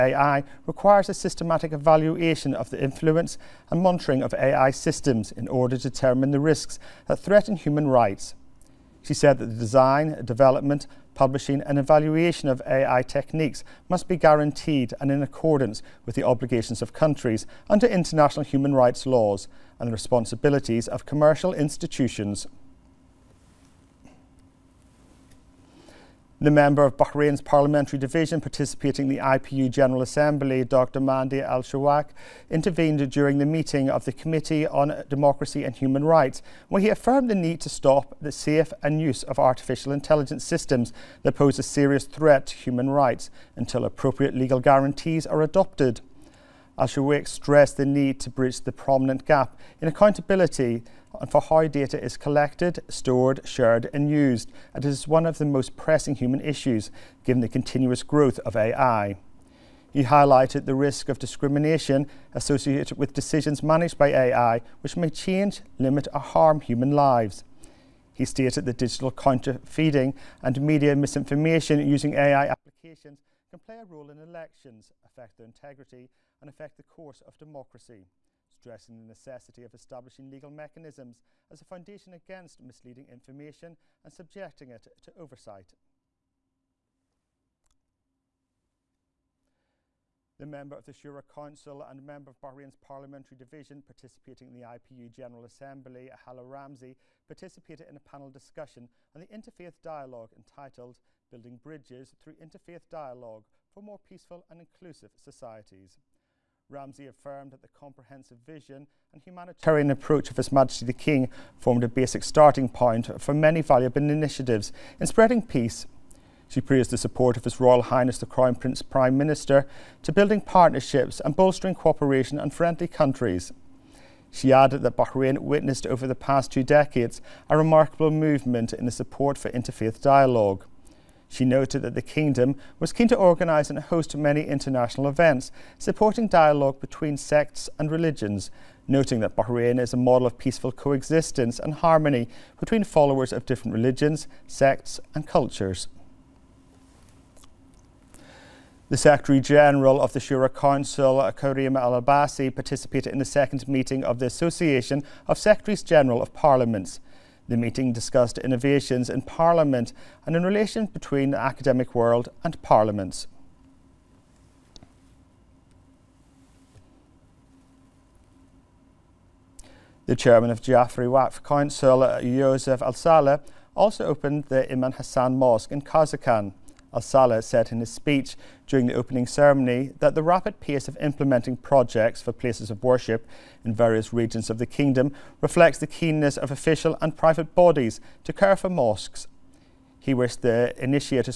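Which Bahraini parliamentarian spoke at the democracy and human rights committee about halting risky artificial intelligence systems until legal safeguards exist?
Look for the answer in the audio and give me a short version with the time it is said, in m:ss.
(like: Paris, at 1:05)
Mahdi Al Shawak, at 0:30.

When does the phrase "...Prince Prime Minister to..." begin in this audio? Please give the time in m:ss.
1:58.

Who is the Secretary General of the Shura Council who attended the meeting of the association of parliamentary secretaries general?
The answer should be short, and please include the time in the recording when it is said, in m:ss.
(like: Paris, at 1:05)
Karim Al Abassi, at 2:31.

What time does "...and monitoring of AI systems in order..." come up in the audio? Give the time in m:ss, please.
0:03.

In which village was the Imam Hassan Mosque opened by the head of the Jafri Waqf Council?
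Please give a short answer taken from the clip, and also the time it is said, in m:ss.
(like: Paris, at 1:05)
Karzakan, at 2:55.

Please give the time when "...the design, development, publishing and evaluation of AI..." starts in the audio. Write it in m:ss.
0:09.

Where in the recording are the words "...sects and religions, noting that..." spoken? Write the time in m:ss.
2:17.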